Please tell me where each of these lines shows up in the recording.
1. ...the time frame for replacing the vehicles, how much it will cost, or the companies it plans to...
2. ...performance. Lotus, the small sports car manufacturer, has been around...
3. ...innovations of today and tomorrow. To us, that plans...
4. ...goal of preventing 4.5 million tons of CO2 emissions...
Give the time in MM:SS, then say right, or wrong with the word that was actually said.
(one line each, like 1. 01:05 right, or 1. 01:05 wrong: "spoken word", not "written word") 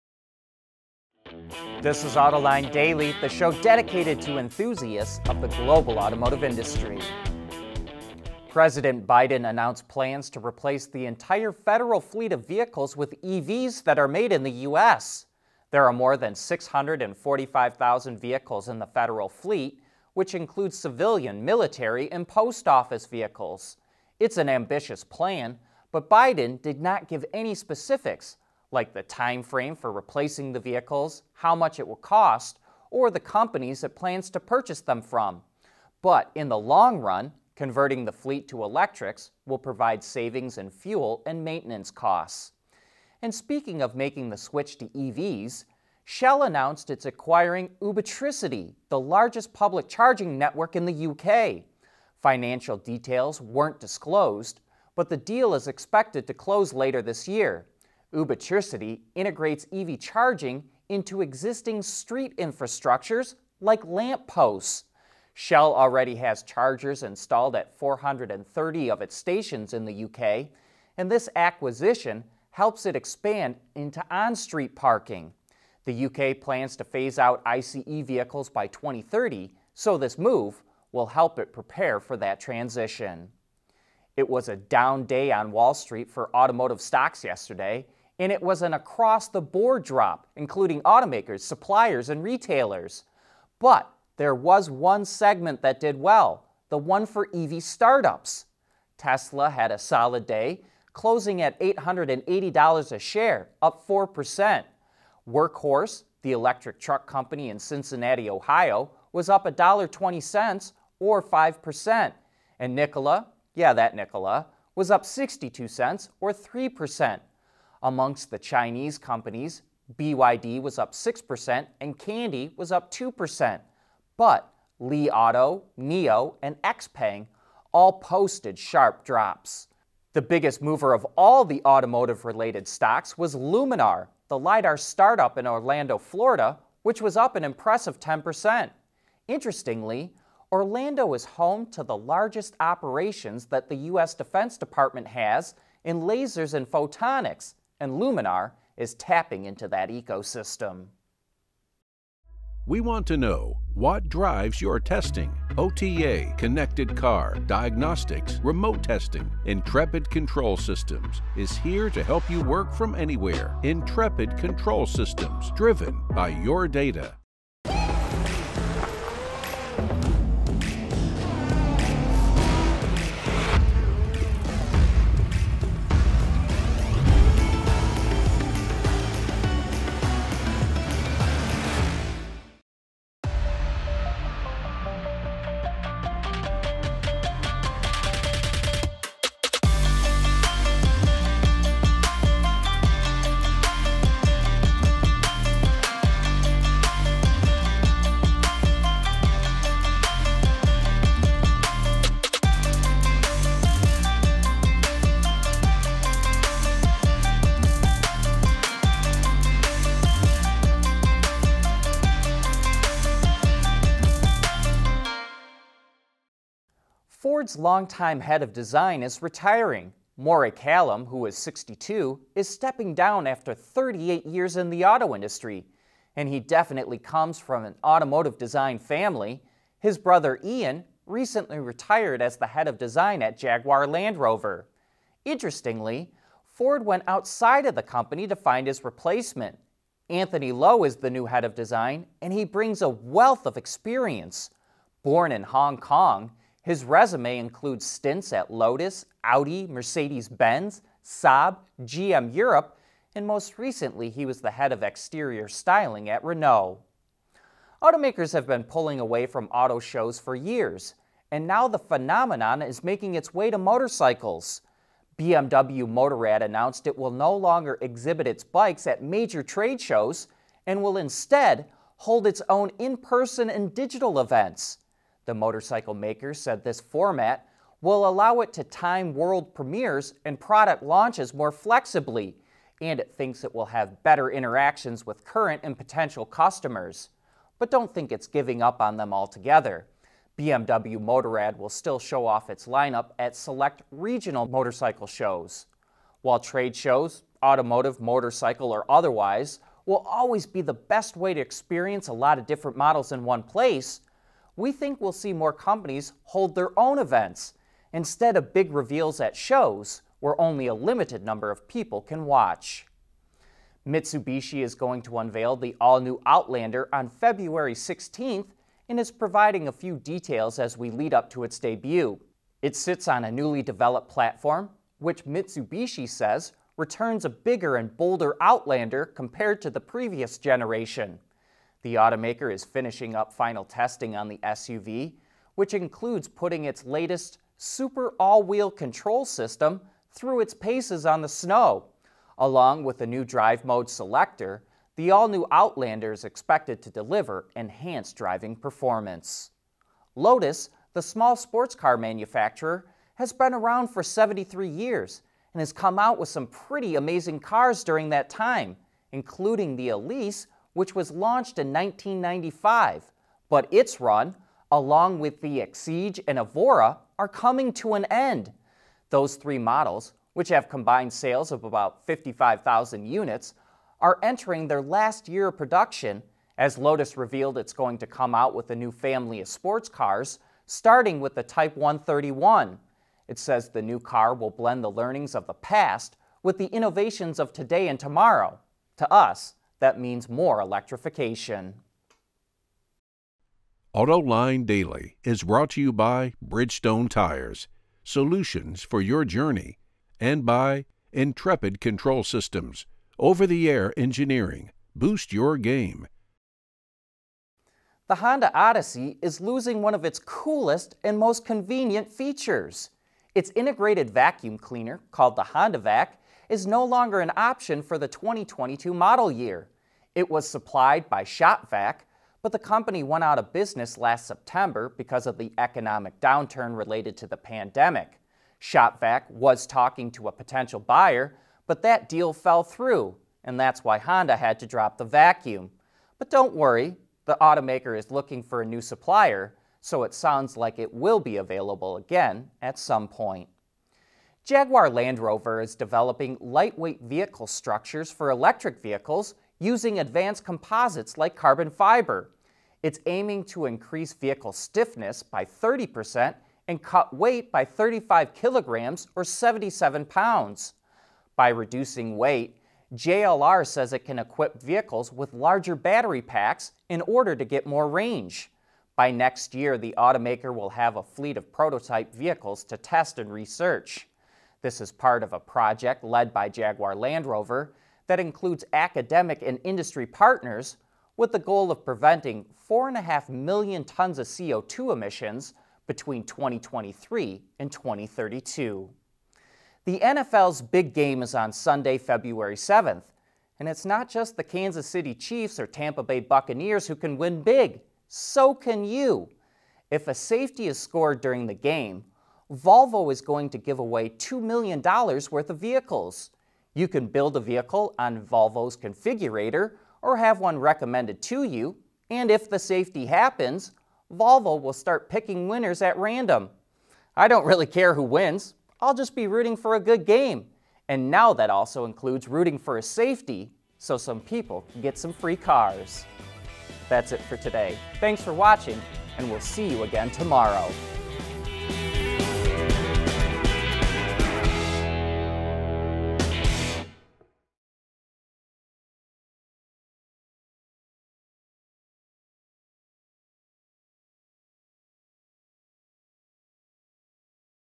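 1. 00:28 right
2. 05:48 right
3. 06:26 wrong: "means", not "plans"
4. 08:01 right.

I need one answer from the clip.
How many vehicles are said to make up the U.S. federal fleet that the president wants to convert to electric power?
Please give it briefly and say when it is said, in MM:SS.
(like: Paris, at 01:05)
645,000, at 00:16.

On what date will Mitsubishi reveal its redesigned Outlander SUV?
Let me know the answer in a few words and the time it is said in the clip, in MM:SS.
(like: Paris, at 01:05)
February 16th, at 05:17.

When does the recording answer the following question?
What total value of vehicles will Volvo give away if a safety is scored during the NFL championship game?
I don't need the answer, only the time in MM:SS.
08:24.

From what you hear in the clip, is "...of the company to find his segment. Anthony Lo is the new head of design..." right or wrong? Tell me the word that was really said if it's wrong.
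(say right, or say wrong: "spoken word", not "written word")
wrong: "replacement", not "segment".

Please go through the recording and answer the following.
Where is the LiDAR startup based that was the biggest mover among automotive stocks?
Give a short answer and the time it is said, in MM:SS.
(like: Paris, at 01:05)
Orlando, Florida, at 02:15.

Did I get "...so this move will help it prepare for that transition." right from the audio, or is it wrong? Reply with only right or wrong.
right.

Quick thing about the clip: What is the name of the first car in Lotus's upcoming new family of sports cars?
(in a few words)
Type 131.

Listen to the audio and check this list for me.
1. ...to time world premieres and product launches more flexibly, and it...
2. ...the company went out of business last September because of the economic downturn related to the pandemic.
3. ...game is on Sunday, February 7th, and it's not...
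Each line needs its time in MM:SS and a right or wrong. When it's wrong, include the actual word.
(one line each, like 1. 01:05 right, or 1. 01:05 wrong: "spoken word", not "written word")
1. 04:38 right
2. 07:02 right
3. 08:10 right.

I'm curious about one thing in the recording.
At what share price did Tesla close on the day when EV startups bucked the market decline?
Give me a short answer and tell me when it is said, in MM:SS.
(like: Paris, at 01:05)
$880, at 01:41.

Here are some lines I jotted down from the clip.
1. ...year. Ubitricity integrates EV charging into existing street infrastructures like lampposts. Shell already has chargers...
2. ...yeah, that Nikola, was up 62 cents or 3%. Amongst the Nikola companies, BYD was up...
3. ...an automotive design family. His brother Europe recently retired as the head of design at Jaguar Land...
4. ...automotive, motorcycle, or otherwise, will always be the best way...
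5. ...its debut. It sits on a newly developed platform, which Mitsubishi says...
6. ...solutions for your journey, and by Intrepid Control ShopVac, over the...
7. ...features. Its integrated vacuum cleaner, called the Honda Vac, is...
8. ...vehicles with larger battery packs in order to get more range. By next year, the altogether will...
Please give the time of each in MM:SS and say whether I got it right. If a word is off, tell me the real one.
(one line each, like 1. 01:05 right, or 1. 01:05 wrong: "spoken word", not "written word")
1. 00:57 right
2. 01:53 wrong: "Chinese", not "Nikola"
3. 03:47 wrong: "Ian", not "Europe"
4. 04:57 right
5. 05:21 right
6. 06:38 wrong: "Systems", not "ShopVac"
7. 06:52 right
8. 07:44 wrong: "automaker", not "altogether".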